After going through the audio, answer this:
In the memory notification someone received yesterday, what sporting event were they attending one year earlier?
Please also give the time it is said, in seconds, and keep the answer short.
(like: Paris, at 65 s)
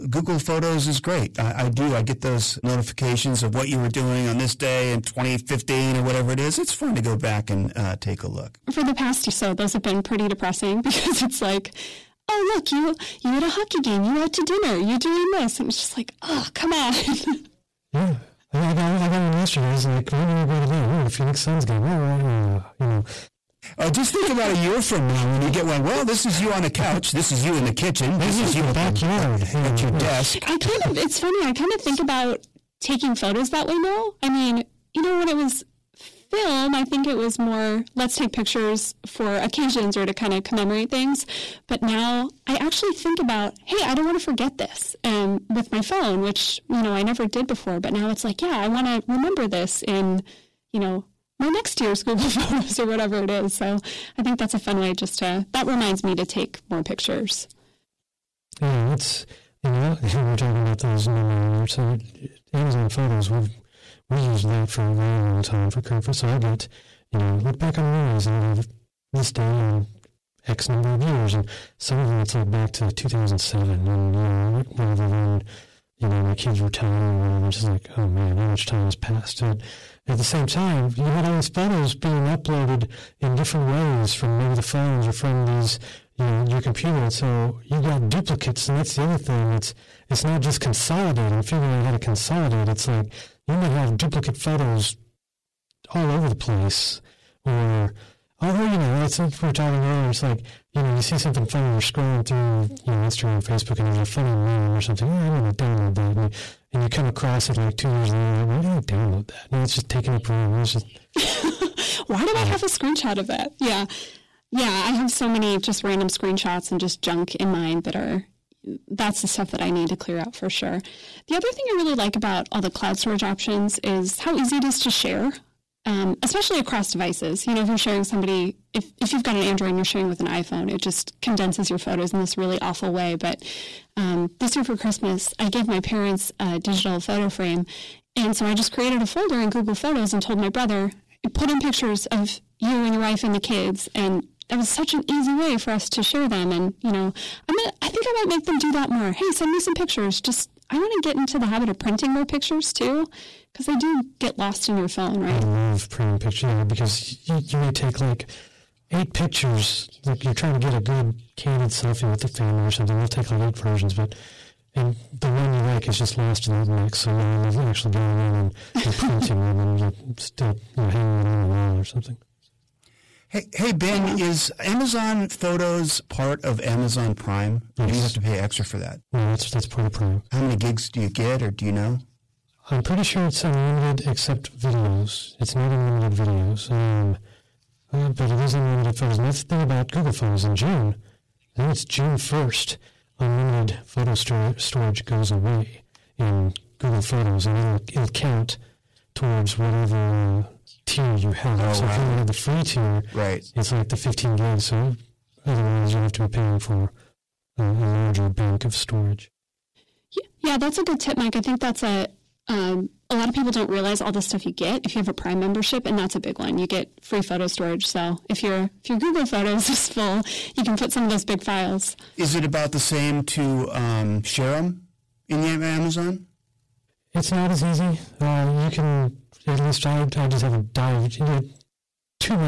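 Phoenix Suns game, at 21 s.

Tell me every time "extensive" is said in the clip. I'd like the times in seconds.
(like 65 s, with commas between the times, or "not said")
not said.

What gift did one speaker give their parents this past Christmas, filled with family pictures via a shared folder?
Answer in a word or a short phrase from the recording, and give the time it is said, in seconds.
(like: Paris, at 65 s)
digital photo frame, at 136 s.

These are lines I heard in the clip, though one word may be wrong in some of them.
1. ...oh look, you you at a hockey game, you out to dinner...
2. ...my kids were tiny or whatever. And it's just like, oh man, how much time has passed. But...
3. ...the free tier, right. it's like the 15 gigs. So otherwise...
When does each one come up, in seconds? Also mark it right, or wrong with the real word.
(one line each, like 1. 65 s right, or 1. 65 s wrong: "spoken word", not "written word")
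1. 12 s right
2. 76 s right
3. 202 s right.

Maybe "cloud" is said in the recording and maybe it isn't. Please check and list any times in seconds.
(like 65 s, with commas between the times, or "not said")
122 s.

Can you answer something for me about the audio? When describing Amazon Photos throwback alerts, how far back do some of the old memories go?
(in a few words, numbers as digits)
2007.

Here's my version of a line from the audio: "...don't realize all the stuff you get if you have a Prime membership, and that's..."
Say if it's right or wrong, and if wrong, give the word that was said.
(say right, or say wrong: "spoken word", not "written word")
right.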